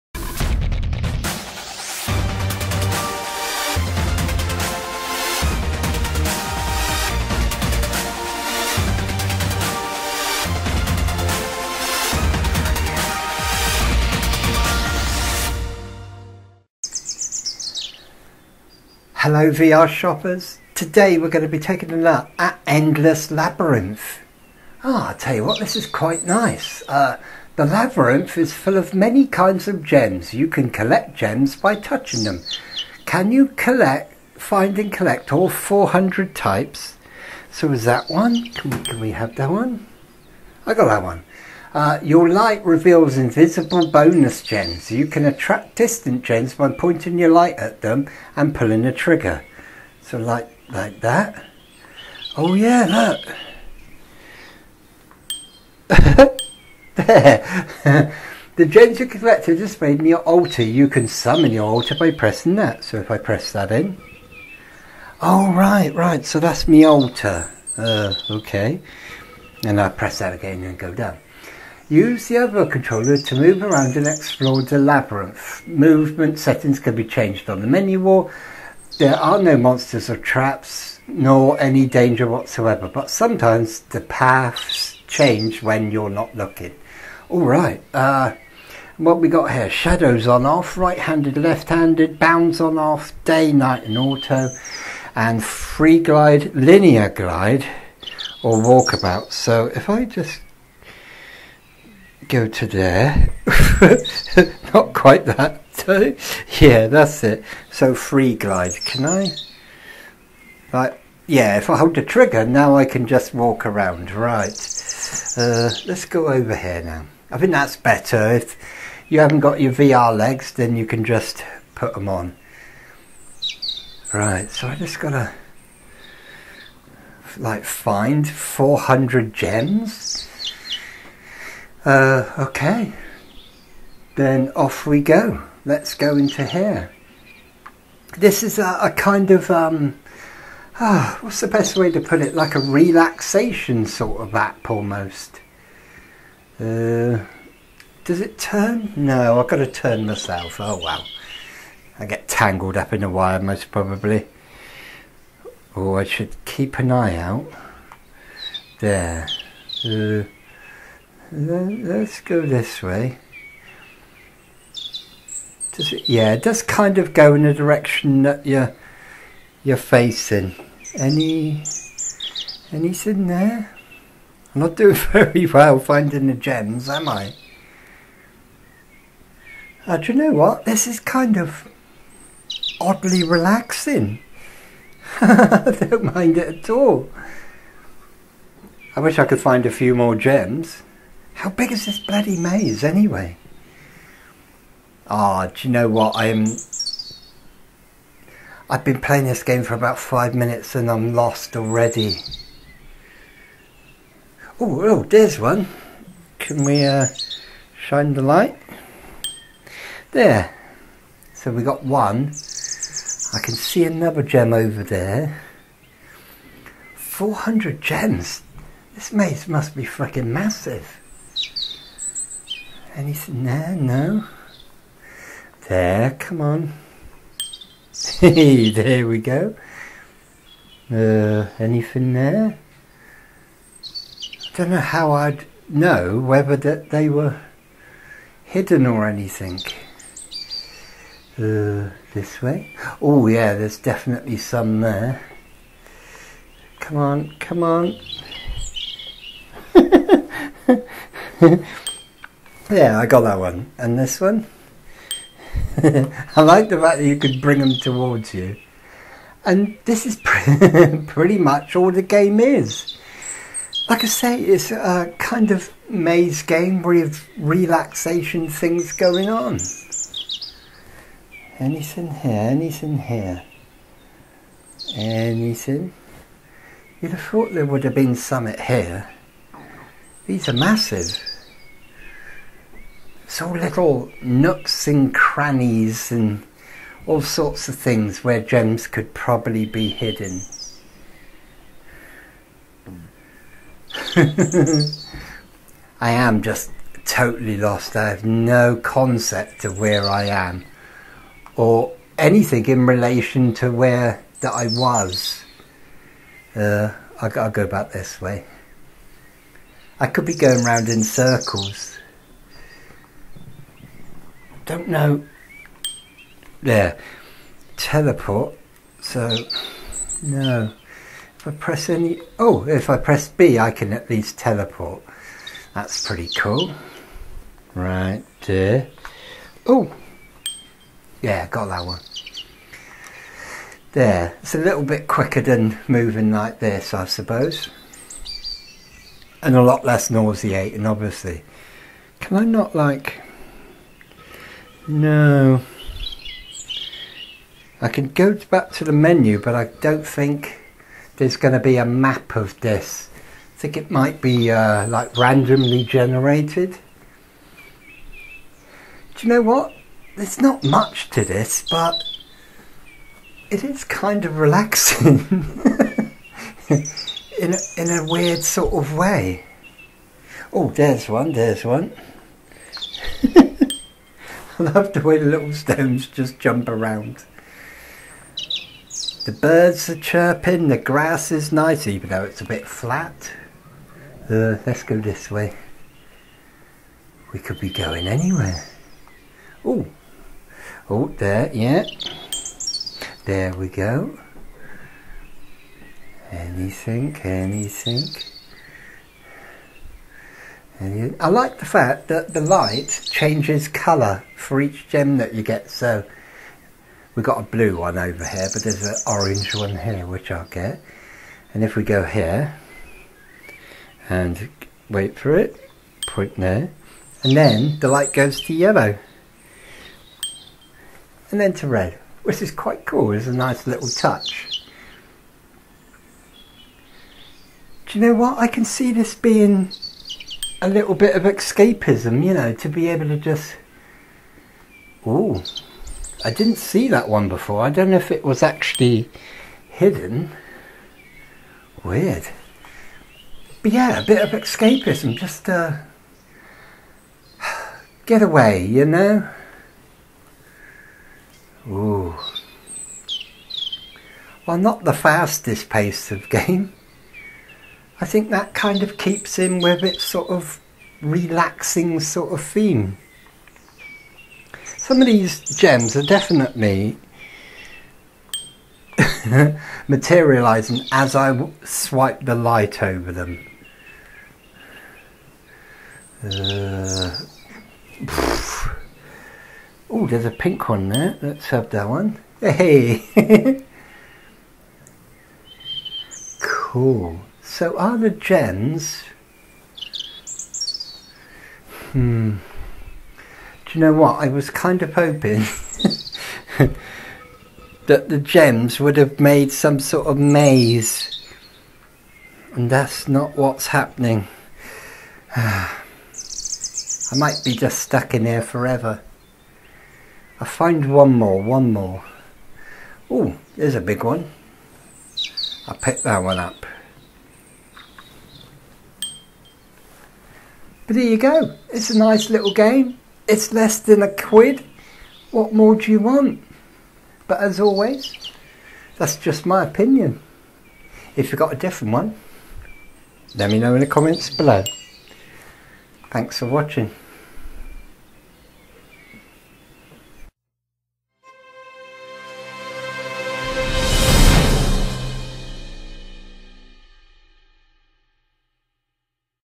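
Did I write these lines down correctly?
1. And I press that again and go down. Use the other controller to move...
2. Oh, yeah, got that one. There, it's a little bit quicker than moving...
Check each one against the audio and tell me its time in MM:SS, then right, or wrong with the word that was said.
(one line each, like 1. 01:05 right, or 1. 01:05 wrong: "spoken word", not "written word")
1. 01:09 right
2. 05:29 right.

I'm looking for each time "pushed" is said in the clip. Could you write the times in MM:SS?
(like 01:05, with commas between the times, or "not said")
not said.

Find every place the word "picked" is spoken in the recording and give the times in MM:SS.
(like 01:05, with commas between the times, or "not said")
08:35.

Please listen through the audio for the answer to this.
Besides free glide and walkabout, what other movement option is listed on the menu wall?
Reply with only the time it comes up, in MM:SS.
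01:36.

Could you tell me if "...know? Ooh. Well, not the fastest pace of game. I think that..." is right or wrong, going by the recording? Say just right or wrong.
right.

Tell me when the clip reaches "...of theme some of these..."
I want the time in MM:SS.
07:42.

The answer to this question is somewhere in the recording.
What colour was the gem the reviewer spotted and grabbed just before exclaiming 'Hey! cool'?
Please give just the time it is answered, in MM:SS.
08:00.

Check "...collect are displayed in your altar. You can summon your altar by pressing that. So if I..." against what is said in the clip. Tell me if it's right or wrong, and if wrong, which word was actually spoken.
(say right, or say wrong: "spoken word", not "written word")
right.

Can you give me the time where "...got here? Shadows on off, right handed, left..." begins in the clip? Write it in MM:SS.
01:29.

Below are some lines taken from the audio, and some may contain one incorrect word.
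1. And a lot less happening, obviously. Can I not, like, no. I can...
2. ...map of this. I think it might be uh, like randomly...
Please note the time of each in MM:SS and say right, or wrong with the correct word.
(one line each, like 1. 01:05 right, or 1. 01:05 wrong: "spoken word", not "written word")
1. 05:39 wrong: "nauseating", not "happening"
2. 05:51 right.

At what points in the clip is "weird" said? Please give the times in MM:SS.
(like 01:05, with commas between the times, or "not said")
06:08, 07:21.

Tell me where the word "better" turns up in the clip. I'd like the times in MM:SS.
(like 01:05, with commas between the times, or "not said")
01:57.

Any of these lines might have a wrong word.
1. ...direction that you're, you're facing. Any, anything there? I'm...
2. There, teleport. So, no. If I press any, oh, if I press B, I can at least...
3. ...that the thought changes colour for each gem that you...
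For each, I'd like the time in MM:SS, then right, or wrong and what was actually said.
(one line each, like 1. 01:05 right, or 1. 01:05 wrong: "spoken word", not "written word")
1. 02:47 right
2. 05:16 right
3. 06:42 wrong: "light", not "thought".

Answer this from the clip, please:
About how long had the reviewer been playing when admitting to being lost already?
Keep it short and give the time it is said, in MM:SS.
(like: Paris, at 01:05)
5 minutes, at 03:19.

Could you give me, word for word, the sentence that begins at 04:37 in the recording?
You'd have thought there would have been some here.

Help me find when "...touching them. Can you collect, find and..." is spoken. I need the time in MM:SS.
00:31.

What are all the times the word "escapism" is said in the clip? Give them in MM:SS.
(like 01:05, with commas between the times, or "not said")
07:11, 07:24.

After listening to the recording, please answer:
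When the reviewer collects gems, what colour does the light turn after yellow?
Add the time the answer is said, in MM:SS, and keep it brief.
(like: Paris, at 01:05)
red, at 07:01.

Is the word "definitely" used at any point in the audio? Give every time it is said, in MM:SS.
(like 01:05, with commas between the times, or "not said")
04:03, 07:46.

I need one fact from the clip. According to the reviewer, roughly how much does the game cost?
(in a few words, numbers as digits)
less than a quid.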